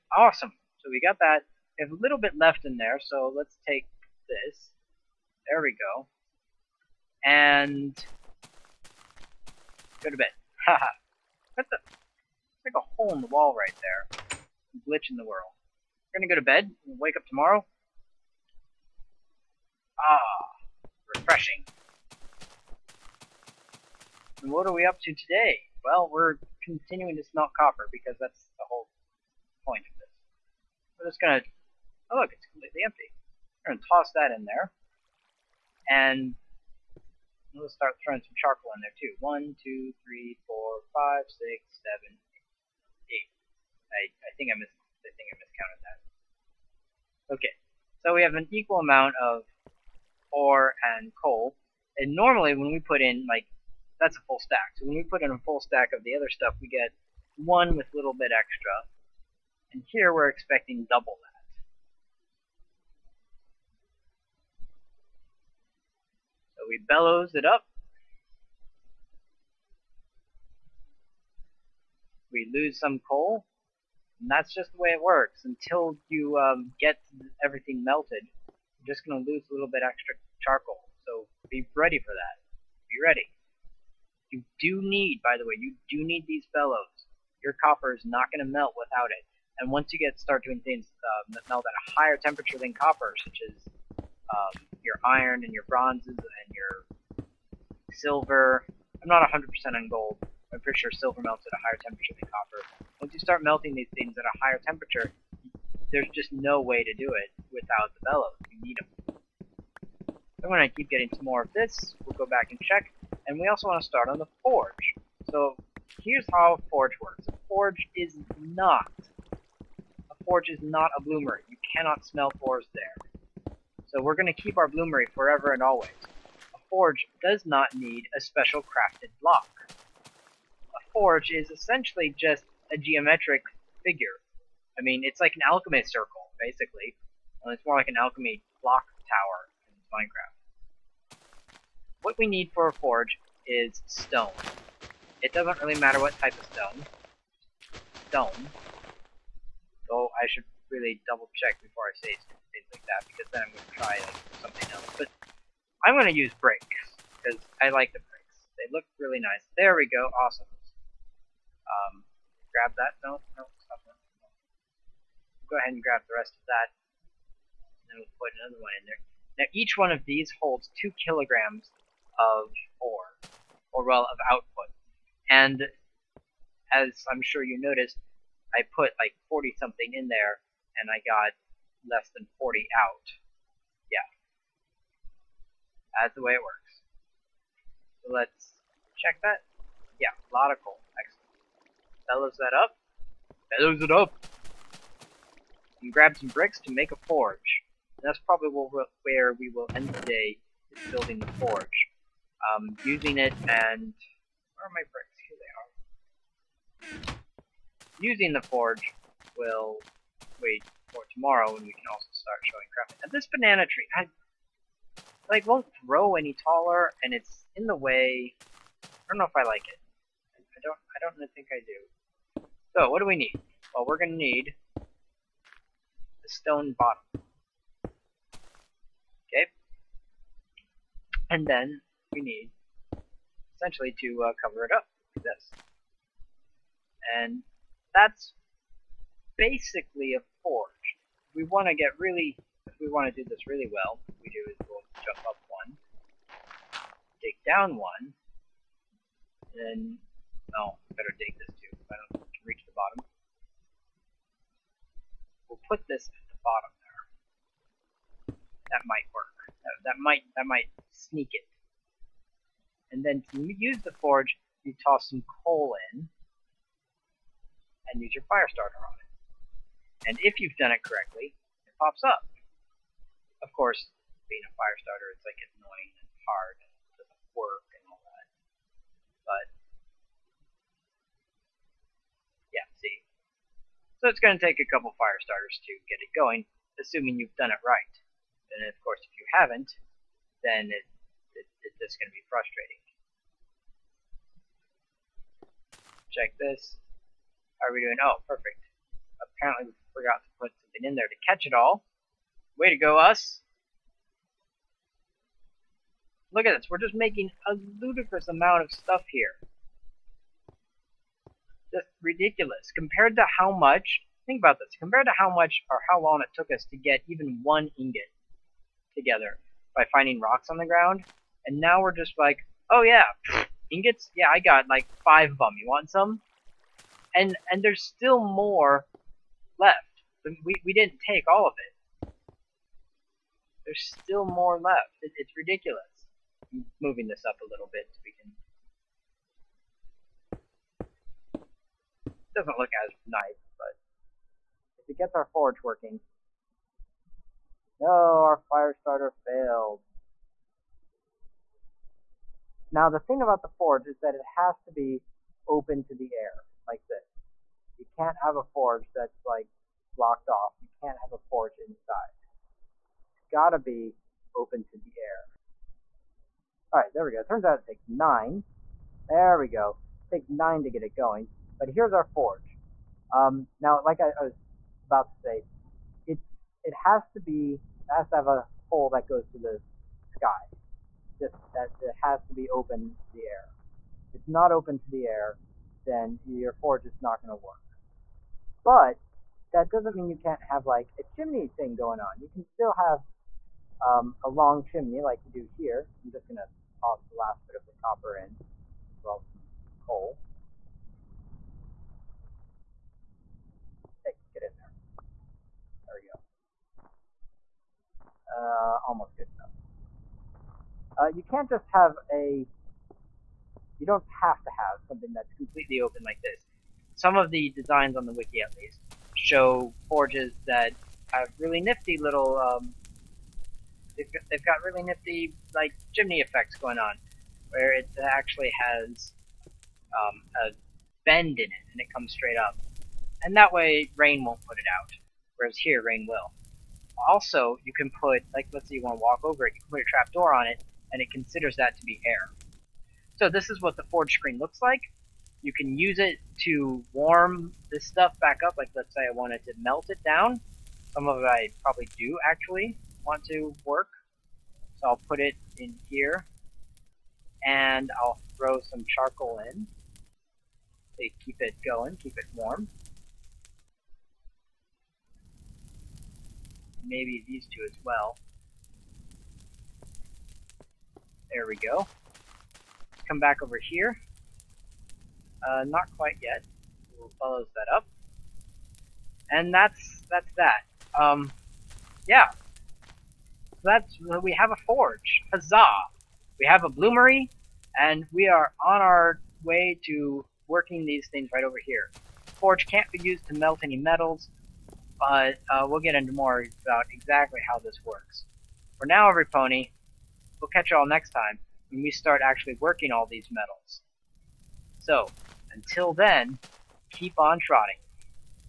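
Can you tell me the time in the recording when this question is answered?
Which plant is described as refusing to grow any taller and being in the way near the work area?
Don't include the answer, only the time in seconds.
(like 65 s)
213 s.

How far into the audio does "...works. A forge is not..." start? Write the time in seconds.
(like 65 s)
117 s.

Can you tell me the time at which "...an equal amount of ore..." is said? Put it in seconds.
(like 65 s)
48 s.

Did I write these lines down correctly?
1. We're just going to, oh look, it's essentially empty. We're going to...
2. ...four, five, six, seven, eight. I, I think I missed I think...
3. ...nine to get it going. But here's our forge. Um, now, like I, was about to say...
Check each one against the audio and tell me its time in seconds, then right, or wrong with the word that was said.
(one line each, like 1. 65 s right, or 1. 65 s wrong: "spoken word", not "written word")
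1. 30 s wrong: "completely", not "essentially"
2. 40 s right
3. 370 s right.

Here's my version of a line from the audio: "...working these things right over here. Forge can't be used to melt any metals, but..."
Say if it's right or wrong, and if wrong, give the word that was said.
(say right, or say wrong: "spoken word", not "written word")
right.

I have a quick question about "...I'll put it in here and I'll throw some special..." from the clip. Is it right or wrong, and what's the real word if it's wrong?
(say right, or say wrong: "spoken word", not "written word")
wrong: "charcoal", not "special".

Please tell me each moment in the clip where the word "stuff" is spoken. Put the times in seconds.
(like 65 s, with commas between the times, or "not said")
56 s, 308 s, 447 s.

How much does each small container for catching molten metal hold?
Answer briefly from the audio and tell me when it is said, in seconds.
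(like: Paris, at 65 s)
2 kilograms, at 170 s.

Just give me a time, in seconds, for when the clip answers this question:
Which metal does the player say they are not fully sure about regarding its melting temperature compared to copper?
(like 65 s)
99 s.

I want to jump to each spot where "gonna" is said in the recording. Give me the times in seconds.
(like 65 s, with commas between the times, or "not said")
16 s, 223 s.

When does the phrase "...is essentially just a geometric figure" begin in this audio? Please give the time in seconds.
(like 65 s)
131 s.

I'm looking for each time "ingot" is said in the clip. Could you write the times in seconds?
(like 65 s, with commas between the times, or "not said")
317 s, 323 s.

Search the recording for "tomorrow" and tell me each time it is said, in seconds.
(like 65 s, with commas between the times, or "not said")
17 s, 211 s.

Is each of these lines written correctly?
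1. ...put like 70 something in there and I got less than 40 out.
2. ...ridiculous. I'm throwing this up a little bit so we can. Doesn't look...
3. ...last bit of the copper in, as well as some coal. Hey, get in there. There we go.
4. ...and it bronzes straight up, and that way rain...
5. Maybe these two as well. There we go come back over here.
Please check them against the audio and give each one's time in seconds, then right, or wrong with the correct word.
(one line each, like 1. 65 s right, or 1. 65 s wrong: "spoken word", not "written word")
1. 178 s wrong: "40", not "70"
2. 335 s wrong: "moving", not "throwing"
3. 397 s right
4. 431 s wrong: "comes", not "bronzes"
5. 466 s right.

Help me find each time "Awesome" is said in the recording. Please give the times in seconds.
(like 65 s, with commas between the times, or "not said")
0 s, 160 s.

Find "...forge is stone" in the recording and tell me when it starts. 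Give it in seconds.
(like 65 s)
142 s.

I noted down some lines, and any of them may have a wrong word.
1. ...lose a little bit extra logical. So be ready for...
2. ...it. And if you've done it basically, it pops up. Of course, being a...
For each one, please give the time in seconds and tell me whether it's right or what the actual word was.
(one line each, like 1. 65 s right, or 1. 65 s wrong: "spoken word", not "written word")
1. 79 s wrong: "charcoal", not "logical"
2. 268 s wrong: "correctly", not "basically".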